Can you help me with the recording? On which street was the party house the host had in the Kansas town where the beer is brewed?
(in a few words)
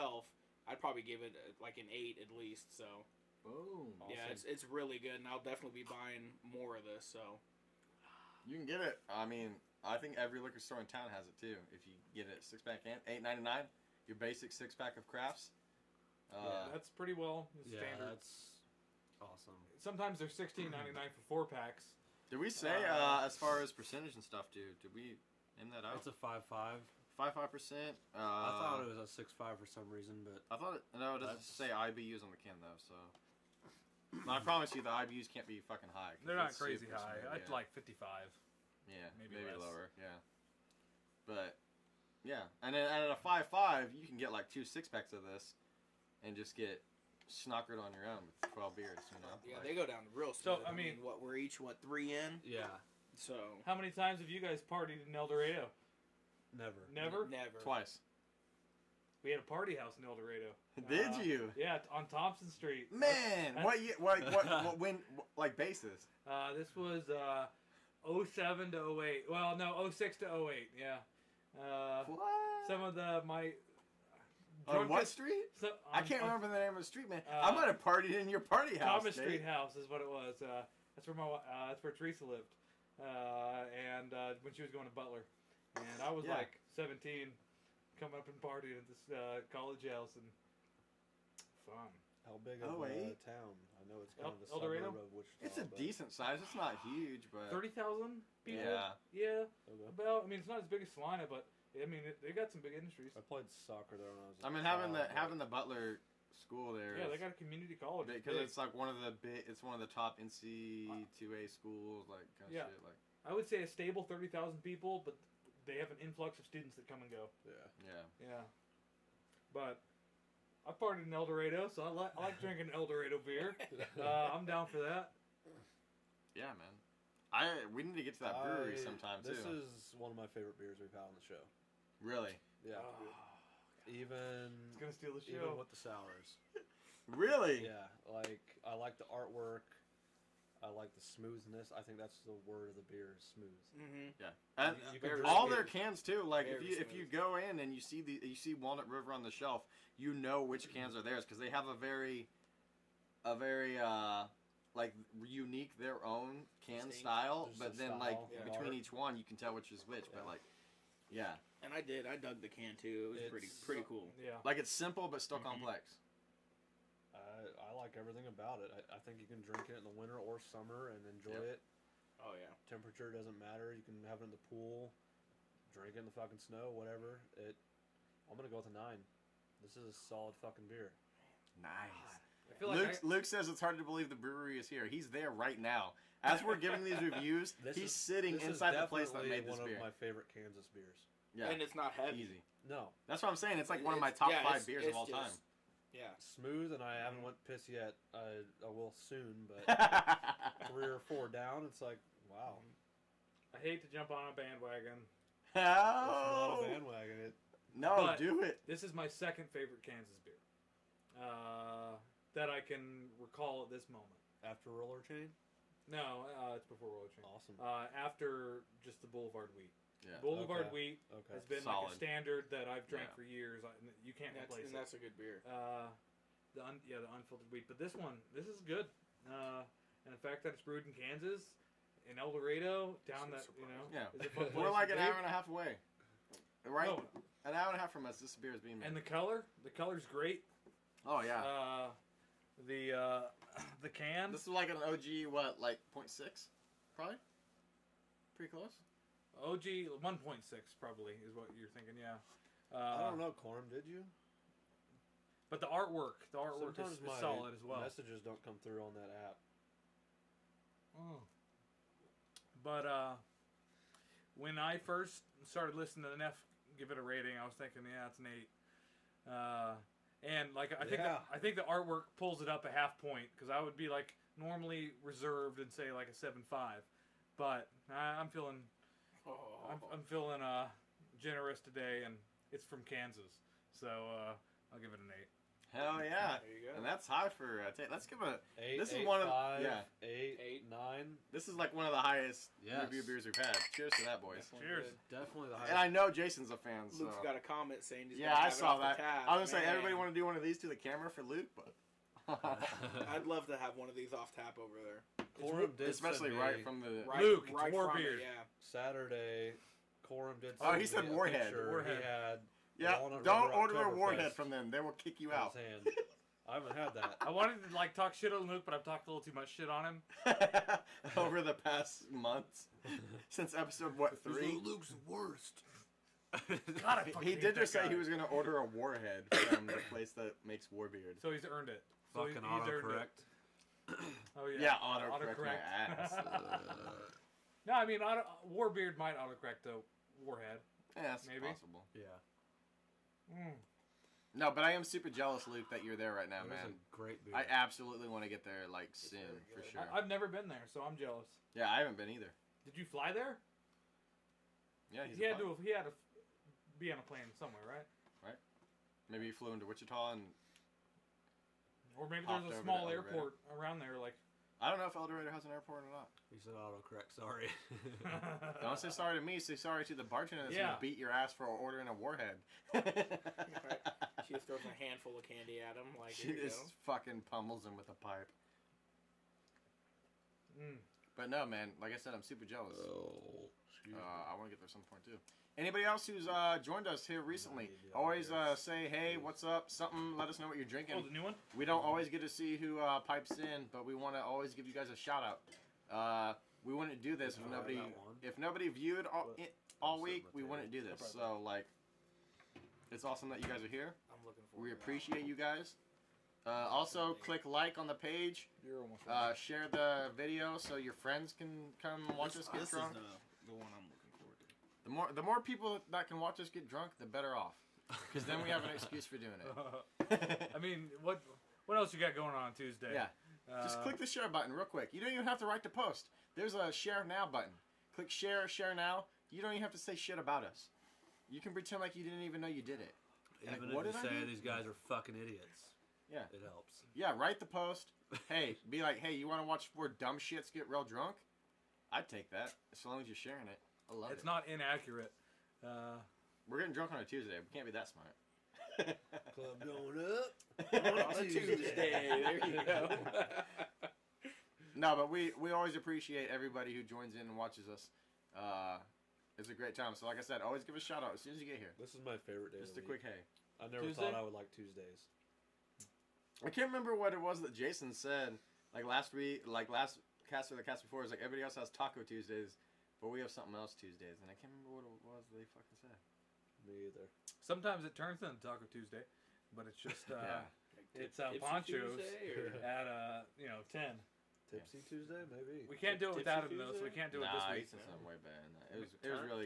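Thompson Street.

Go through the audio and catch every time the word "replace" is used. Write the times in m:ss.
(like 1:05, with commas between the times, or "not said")
3:44.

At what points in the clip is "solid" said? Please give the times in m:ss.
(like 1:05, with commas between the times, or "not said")
2:59, 4:17.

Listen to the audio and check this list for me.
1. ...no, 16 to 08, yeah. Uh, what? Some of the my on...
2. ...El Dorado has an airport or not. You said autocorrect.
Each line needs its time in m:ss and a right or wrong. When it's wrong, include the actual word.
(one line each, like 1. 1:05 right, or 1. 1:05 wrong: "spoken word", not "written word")
1. 1:09 wrong: "06", not "16"
2. 6:04 right.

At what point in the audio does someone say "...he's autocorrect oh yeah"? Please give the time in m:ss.
5:32.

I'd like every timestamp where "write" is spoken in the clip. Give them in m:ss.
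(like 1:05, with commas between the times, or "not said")
7:05, 7:17.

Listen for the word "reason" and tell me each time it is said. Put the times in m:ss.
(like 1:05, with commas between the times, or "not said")
0:29.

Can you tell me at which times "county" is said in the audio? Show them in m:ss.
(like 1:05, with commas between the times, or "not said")
not said.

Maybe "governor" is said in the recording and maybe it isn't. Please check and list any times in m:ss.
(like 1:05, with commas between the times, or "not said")
not said.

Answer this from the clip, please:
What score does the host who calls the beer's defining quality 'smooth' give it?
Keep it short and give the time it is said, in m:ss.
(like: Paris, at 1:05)
9, at 2:58.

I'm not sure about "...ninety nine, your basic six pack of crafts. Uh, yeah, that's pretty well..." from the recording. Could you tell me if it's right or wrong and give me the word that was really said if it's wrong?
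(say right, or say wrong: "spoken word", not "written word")
right.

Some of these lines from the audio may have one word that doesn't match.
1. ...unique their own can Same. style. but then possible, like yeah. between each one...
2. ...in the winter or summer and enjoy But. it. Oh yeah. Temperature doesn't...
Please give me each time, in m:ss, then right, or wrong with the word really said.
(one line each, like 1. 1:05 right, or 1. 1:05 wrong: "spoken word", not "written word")
1. 2:35 wrong: "style", not "possible"
2. 2:49 wrong: "Yep", not "But".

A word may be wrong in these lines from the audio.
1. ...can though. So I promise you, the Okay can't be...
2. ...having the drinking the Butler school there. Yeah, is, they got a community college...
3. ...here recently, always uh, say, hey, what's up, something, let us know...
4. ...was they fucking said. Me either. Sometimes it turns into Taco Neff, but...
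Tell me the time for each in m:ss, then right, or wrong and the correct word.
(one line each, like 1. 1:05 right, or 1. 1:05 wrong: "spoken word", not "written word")
1. 0:32 wrong: "IBUs", not "Okay"
2. 1:44 wrong: "having", not "drinking"
3. 6:27 right
4. 7:55 wrong: "Tuesday", not "Neff".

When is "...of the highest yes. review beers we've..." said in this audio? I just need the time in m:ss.
4:51.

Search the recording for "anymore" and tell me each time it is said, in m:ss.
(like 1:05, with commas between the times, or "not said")
not said.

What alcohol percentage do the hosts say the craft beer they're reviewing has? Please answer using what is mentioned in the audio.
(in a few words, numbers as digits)
5.5%.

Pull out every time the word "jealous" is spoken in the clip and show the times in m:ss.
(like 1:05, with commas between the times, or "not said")
5:45, 5:50, 6:22.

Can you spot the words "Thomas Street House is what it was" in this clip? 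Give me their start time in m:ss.
1:19.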